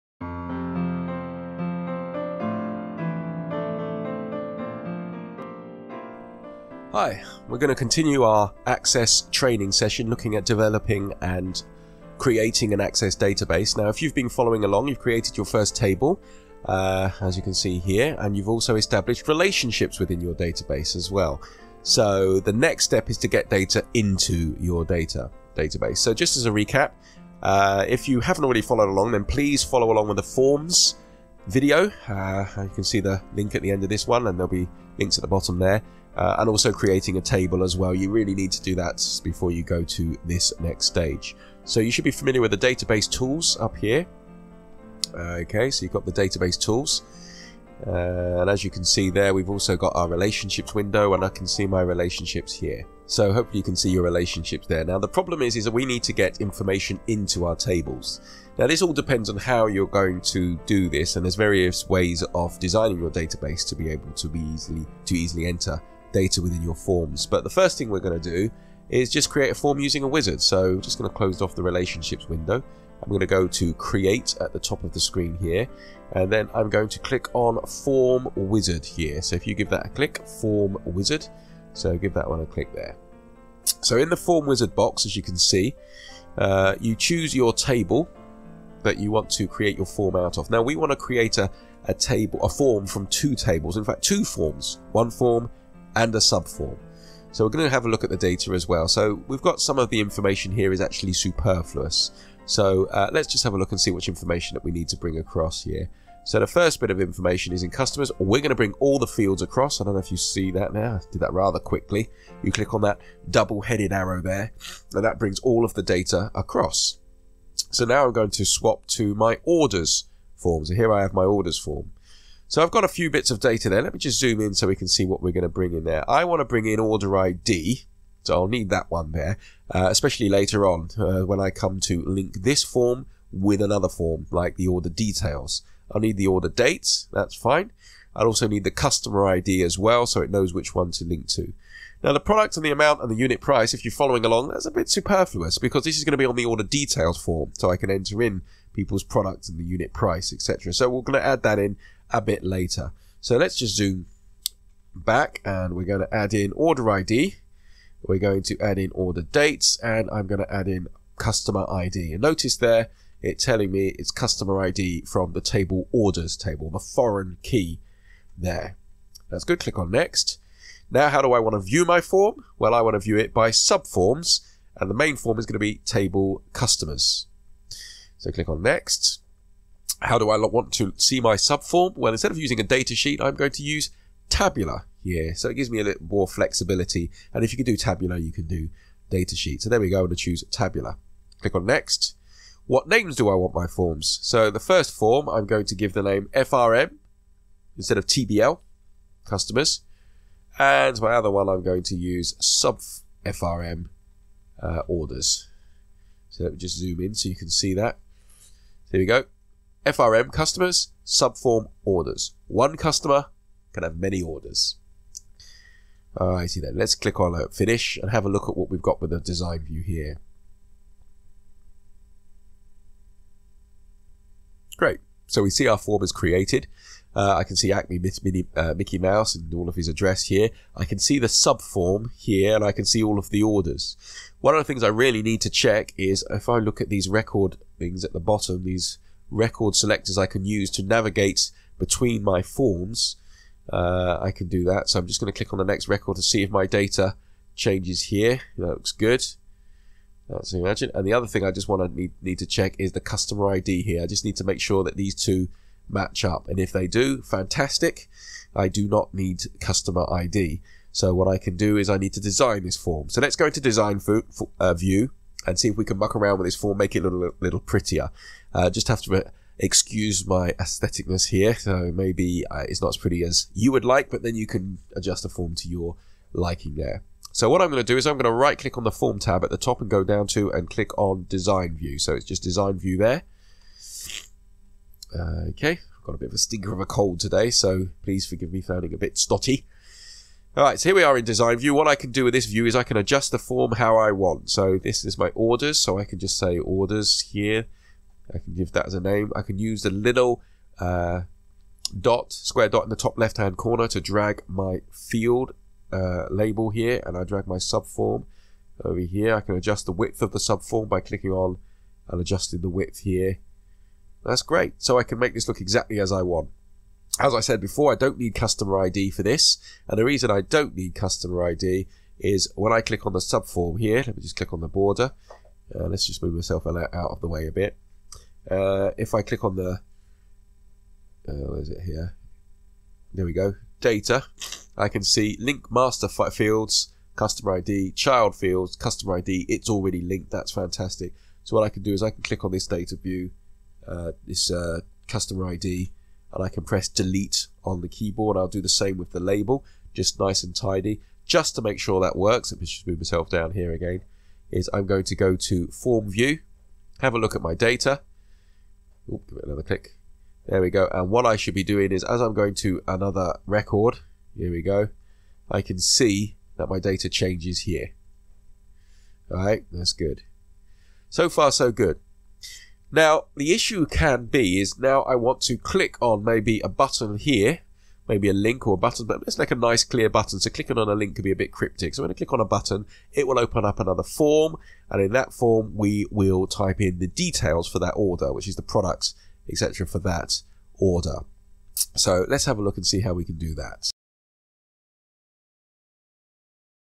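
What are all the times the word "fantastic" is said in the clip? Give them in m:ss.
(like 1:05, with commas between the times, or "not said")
4:17, 5:40.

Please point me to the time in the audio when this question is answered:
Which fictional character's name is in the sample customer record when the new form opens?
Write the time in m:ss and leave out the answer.
3:48.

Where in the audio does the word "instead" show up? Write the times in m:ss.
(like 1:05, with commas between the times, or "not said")
3:02, 3:17.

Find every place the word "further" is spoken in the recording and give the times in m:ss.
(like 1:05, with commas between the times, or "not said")
not said.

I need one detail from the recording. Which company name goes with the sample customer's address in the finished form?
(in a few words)
Acme.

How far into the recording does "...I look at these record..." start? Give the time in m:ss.
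3:56.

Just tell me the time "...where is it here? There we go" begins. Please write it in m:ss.
5:31.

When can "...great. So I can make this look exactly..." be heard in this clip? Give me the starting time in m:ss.
5:14.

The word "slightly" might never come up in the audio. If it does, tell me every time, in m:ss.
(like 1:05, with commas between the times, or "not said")
not said.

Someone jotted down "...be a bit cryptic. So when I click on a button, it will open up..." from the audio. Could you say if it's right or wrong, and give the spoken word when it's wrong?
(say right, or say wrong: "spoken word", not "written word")
right.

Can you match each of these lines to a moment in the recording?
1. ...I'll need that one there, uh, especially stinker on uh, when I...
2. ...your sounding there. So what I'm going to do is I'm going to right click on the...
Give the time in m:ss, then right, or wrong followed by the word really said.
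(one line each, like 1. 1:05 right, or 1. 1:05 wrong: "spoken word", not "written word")
1. 2:08 wrong: "later", not "stinker"
2. 4:35 wrong: "liking", not "sounding".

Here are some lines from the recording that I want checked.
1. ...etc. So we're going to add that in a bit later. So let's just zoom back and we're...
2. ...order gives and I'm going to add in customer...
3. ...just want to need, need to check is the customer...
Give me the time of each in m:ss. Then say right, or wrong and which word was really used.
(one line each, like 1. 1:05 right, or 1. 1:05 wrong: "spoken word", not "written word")
1. 2:30 right
2. 2:38 wrong: "dates", not "gives"
3. 4:11 right.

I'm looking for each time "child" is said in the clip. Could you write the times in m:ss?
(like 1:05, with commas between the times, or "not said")
5:37.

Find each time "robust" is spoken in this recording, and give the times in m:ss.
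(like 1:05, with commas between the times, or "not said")
not said.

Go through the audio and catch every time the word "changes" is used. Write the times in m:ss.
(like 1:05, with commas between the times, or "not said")
4:07, 6:07.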